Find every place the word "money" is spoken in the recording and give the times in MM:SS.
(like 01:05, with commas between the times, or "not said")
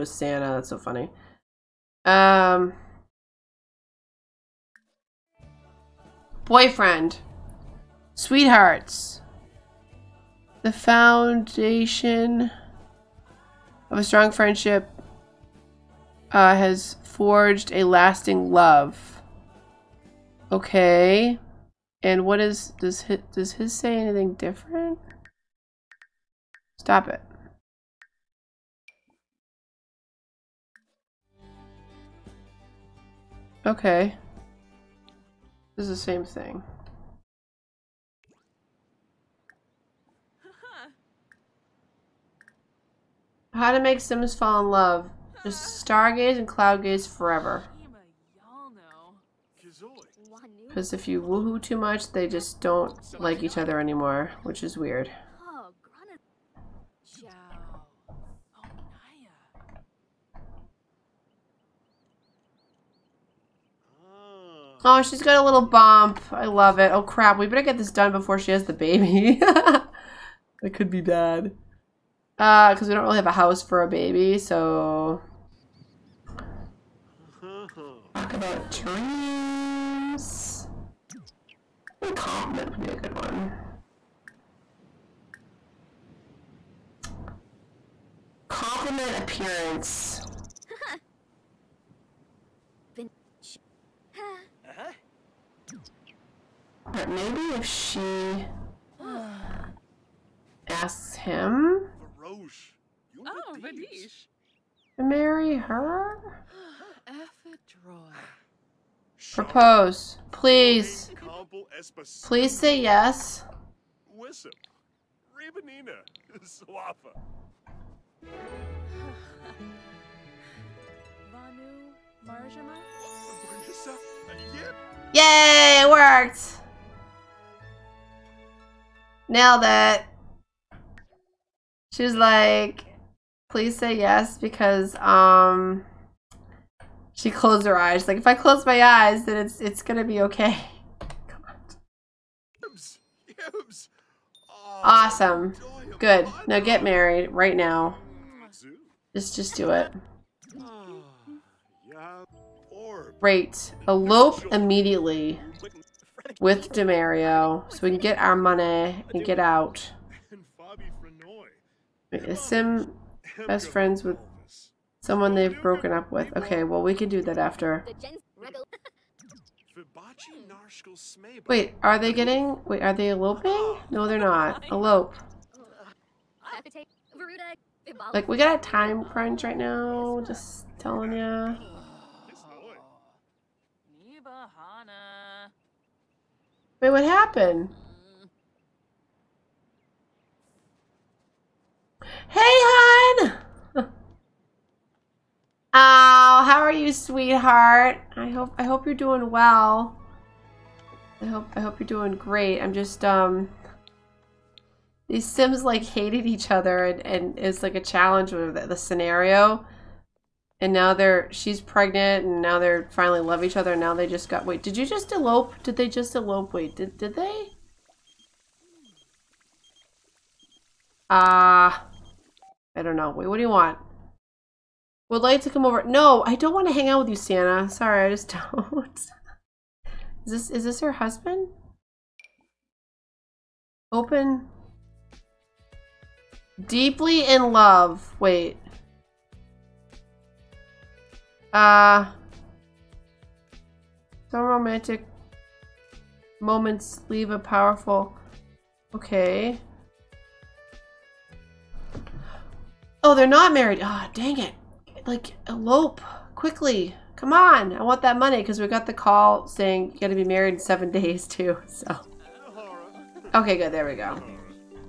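02:38, 04:18.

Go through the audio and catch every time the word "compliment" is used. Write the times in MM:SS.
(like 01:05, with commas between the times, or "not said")
01:22, 01:28.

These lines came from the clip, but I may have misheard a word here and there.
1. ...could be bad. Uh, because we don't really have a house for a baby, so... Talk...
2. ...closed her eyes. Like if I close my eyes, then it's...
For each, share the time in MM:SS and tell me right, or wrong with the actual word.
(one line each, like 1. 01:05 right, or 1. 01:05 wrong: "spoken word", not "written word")
1. 01:10 right
2. 02:17 right.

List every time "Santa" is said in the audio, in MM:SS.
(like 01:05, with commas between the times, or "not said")
00:00, 03:47.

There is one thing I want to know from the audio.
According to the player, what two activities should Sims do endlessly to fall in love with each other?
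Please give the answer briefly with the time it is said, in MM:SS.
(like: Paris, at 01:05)
Stargaze and cloud gaze, at 00:45.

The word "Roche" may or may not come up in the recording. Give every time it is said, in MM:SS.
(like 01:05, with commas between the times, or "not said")
01:42.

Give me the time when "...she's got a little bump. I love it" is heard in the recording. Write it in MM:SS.
01:05.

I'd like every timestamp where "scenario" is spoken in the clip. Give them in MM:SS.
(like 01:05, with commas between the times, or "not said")
03:28.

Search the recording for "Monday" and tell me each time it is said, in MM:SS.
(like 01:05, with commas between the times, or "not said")
not said.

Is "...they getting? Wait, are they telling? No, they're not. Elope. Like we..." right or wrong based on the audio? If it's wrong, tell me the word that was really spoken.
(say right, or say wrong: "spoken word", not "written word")
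wrong: "eloping", not "telling".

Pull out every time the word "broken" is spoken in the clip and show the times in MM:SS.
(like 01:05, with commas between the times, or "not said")
02:45.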